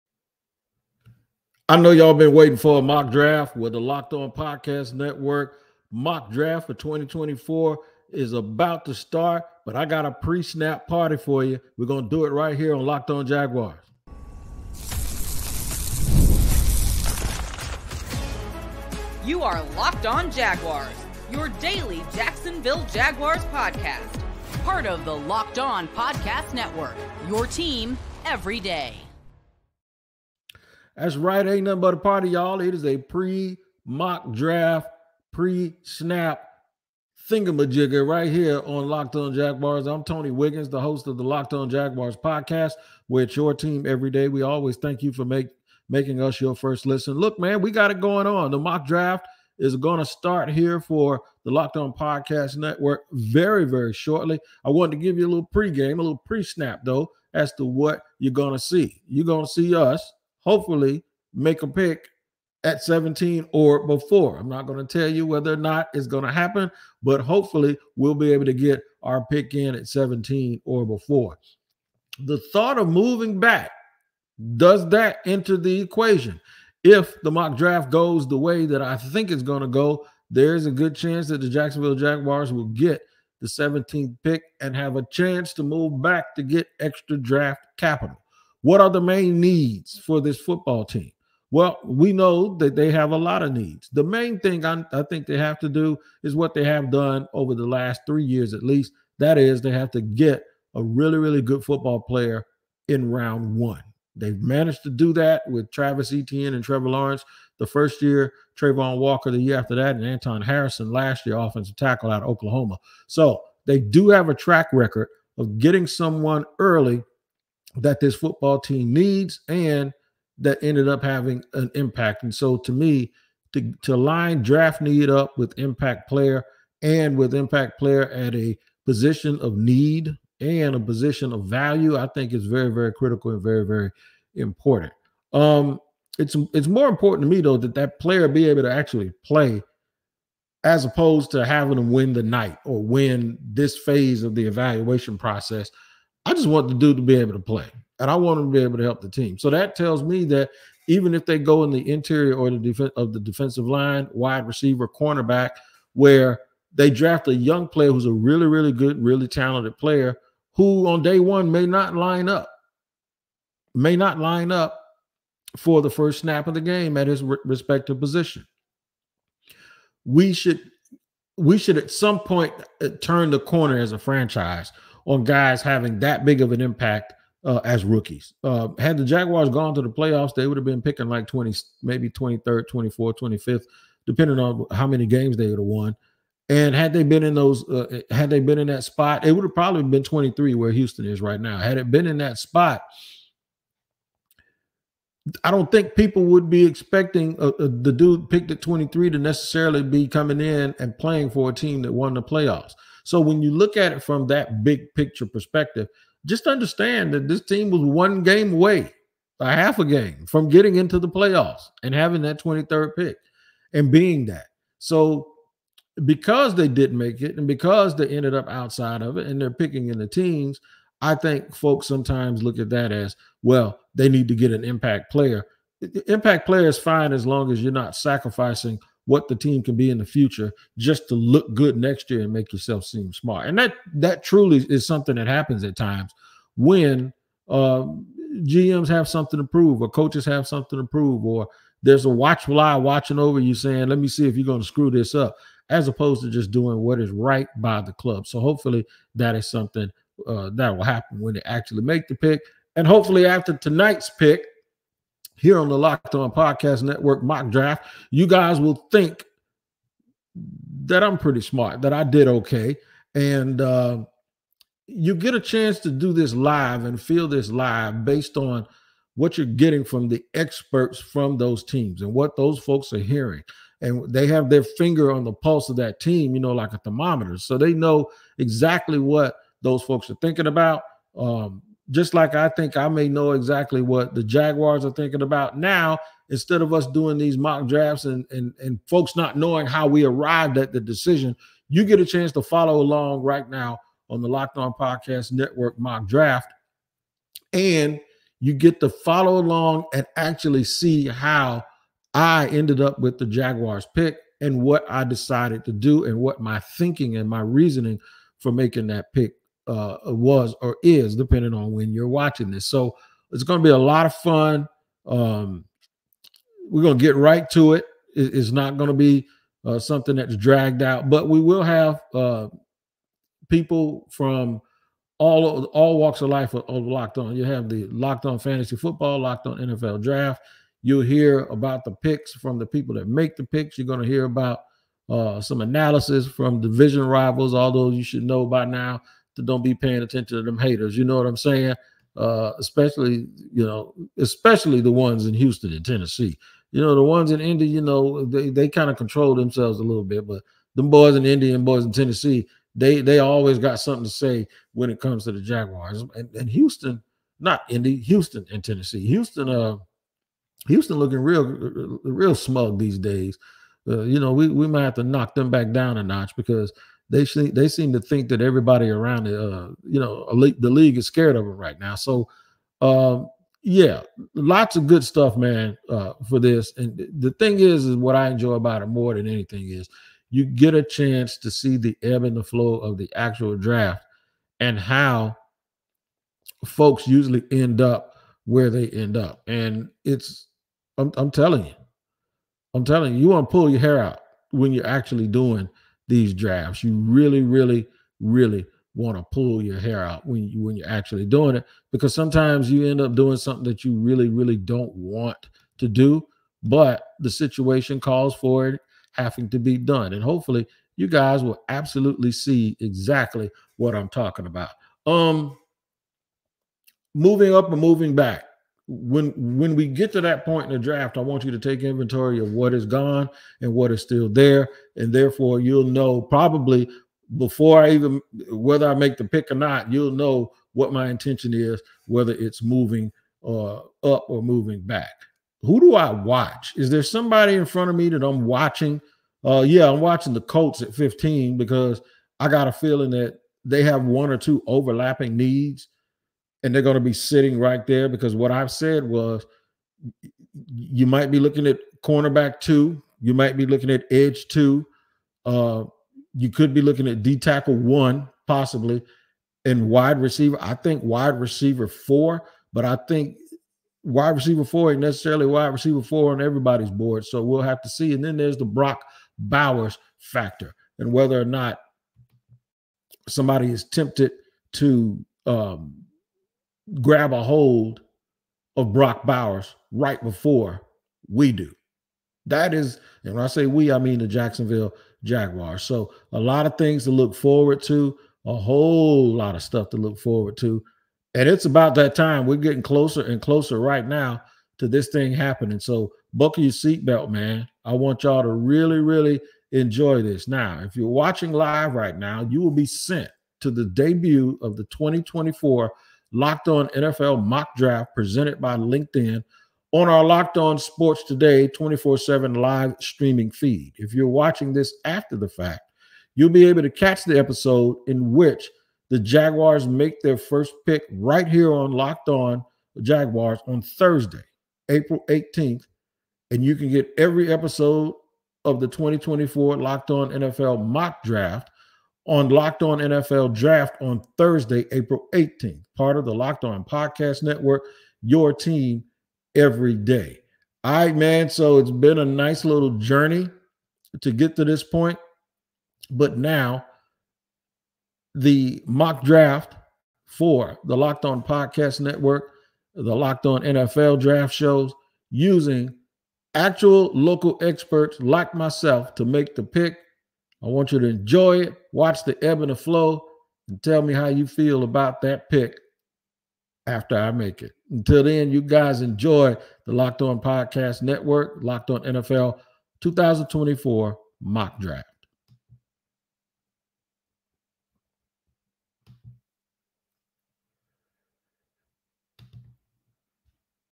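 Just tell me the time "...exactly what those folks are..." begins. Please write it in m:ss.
4:38.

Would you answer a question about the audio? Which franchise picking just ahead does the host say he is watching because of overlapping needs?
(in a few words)
Colts.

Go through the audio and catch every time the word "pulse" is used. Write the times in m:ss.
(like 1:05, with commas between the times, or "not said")
4:35.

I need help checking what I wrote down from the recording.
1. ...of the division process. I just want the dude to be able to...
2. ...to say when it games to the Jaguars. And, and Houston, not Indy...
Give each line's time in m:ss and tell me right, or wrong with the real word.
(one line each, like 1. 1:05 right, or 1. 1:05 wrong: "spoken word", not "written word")
1. 2:24 wrong: "evaluation", not "division"
2. 5:54 wrong: "comes", not "games".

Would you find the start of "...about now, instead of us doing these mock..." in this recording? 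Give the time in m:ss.
4:45.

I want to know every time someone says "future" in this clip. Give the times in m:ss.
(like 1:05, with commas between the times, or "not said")
3:50.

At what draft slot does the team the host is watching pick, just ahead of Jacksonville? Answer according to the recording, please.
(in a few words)
15.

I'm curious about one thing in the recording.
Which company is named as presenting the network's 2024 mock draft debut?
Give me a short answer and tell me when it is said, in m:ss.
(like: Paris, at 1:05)
LinkedIn, at 8:28.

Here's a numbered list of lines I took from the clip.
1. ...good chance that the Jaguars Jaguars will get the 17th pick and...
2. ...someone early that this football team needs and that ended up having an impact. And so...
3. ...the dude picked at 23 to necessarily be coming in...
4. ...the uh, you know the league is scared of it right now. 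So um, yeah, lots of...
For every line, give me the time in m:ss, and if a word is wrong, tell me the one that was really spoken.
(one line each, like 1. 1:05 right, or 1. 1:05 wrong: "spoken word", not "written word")
1. 1:20 wrong: "Jacksonville", not "Jaguars"
2. 1:55 right
3. 3:17 right
4. 6:09 right.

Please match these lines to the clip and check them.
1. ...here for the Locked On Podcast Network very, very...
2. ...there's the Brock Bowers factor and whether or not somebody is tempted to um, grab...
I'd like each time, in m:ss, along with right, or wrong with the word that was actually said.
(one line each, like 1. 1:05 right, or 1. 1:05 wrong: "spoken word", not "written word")
1. 0:50 right
2. 7:48 right.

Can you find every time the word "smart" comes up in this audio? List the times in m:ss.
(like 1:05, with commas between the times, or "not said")
3:53, 4:21.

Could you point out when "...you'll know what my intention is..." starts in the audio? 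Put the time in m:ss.
7:09.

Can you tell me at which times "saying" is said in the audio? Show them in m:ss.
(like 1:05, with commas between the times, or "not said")
4:03, 5:41.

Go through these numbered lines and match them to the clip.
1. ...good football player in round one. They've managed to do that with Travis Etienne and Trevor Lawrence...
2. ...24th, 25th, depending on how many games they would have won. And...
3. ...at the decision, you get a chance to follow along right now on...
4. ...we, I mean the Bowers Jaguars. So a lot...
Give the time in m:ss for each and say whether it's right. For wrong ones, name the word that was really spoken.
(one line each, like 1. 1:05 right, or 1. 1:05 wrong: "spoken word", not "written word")
1. 1:41 right
2. 3:02 right
3. 4:50 right
4. 8:03 wrong: "Jacksonville", not "Bowers".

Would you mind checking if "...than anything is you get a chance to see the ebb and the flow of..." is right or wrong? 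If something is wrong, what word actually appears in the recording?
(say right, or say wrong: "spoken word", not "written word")
right.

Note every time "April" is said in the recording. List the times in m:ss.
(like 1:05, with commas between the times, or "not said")
8:44, 8:54.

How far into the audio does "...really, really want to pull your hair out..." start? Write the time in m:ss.
6:37.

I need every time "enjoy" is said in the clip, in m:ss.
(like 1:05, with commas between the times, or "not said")
6:18, 8:19, 9:21, 9:29.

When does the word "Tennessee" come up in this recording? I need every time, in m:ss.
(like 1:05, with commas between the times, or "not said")
5:45, 5:51, 5:58.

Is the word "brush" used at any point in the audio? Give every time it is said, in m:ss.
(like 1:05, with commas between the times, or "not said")
not said.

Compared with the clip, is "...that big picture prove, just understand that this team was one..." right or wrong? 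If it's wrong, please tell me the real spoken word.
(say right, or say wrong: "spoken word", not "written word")
wrong: "perspective", not "prove".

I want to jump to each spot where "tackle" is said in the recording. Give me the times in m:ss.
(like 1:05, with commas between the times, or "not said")
1:51, 7:37.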